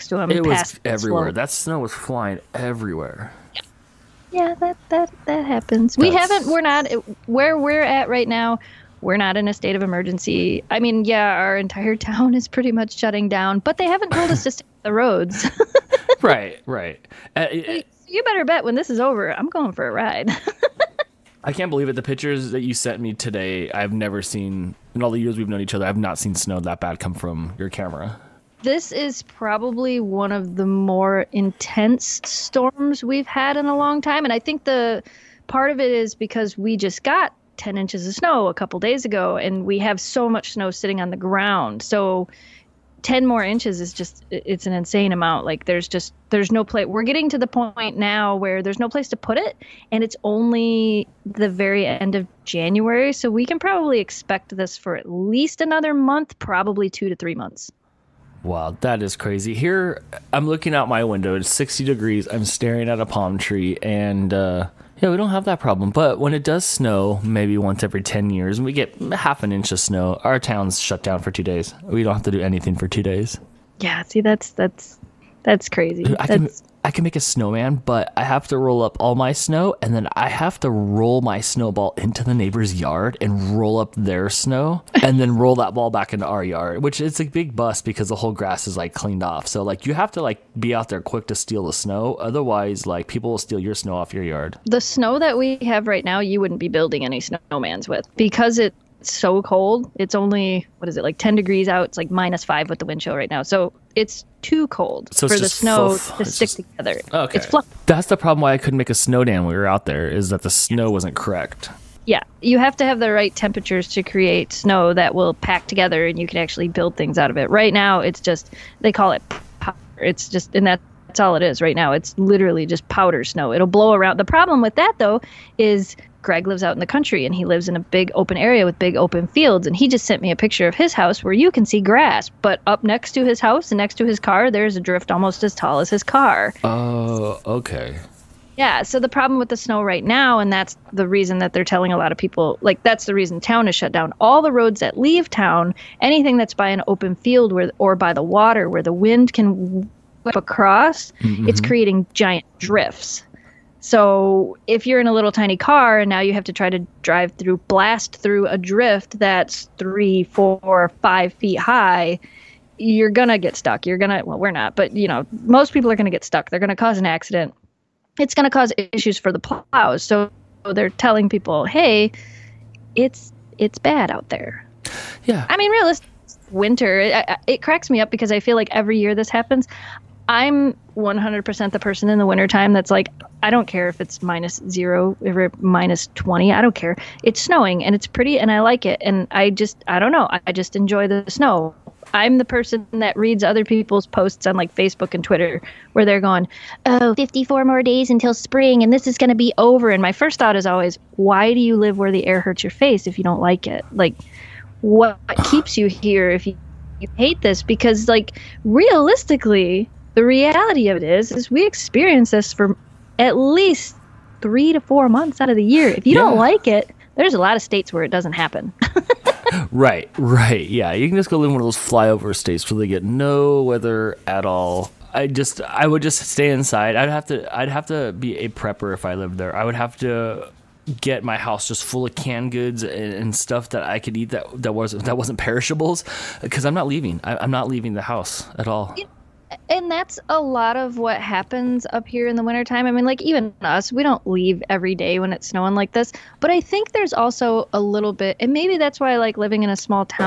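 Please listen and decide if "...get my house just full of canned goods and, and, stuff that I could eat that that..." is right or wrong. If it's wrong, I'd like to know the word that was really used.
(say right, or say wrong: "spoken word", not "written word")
right.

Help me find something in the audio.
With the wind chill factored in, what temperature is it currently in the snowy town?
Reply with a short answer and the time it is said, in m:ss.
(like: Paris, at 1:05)
-5, at 1:42.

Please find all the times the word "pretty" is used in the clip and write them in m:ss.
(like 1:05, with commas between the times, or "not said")
0:12, 3:08.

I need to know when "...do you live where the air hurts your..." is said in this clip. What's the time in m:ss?
3:21.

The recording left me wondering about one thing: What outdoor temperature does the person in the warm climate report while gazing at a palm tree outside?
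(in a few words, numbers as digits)
60 degrees.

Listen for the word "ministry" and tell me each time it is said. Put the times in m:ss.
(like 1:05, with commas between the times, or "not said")
not said.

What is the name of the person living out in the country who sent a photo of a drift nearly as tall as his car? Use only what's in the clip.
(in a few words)
Greg.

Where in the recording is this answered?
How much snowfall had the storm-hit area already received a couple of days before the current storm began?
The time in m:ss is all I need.
0:37.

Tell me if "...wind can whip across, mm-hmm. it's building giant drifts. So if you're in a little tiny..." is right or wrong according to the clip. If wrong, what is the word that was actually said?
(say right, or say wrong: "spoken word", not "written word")
wrong: "creating", not "building".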